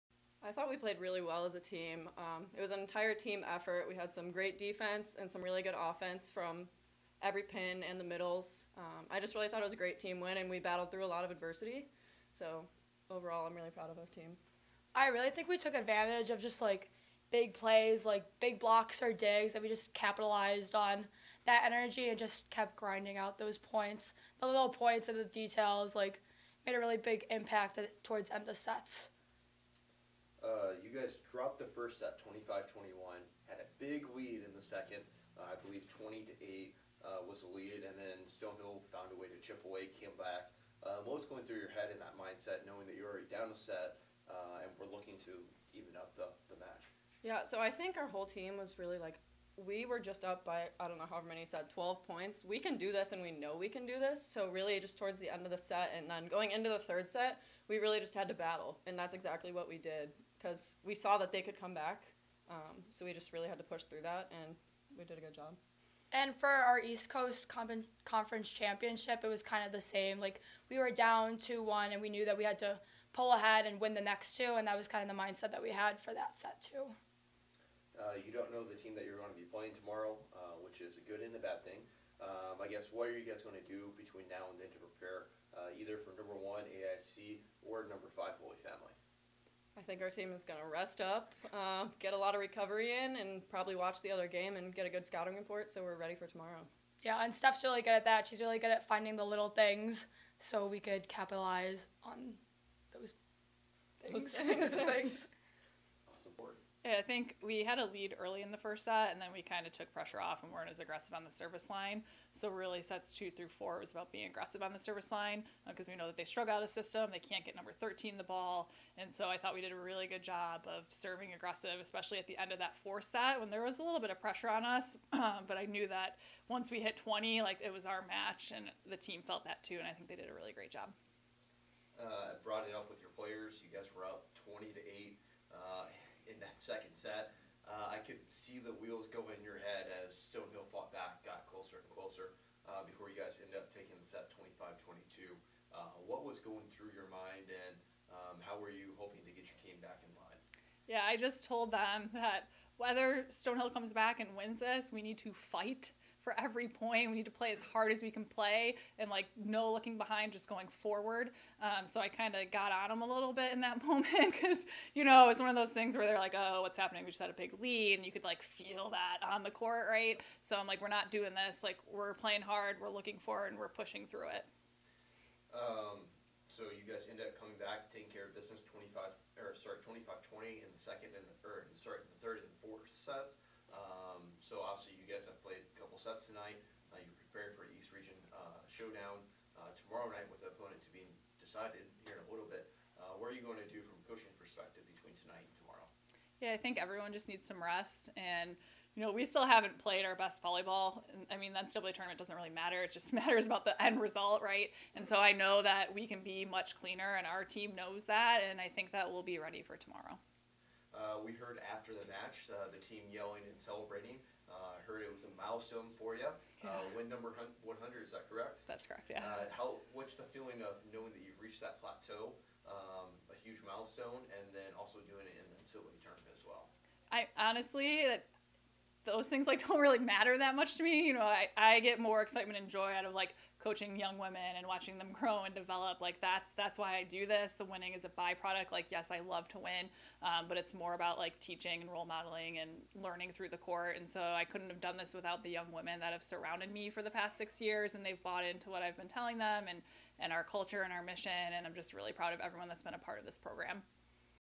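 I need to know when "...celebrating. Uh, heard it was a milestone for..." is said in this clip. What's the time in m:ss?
3:33.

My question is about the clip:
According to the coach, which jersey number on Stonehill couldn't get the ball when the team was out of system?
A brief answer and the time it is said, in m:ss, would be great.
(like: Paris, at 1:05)
13, at 1:57.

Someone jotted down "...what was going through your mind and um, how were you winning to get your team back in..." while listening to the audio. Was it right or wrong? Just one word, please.
wrong.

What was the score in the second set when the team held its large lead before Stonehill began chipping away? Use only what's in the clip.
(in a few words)
20-8.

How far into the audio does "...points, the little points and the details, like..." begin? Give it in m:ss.
0:23.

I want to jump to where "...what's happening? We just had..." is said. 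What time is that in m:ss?
2:46.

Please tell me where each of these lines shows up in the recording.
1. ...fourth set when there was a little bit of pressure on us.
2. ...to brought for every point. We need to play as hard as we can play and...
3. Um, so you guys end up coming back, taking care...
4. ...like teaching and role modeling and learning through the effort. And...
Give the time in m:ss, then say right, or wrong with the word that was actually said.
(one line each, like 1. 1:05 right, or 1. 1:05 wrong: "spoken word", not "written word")
1. 2:02 right
2. 2:35 wrong: "fight", not "brought"
3. 2:55 right
4. 4:01 wrong: "court", not "effort".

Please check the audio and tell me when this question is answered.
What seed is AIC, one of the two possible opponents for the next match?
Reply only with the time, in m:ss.
1:26.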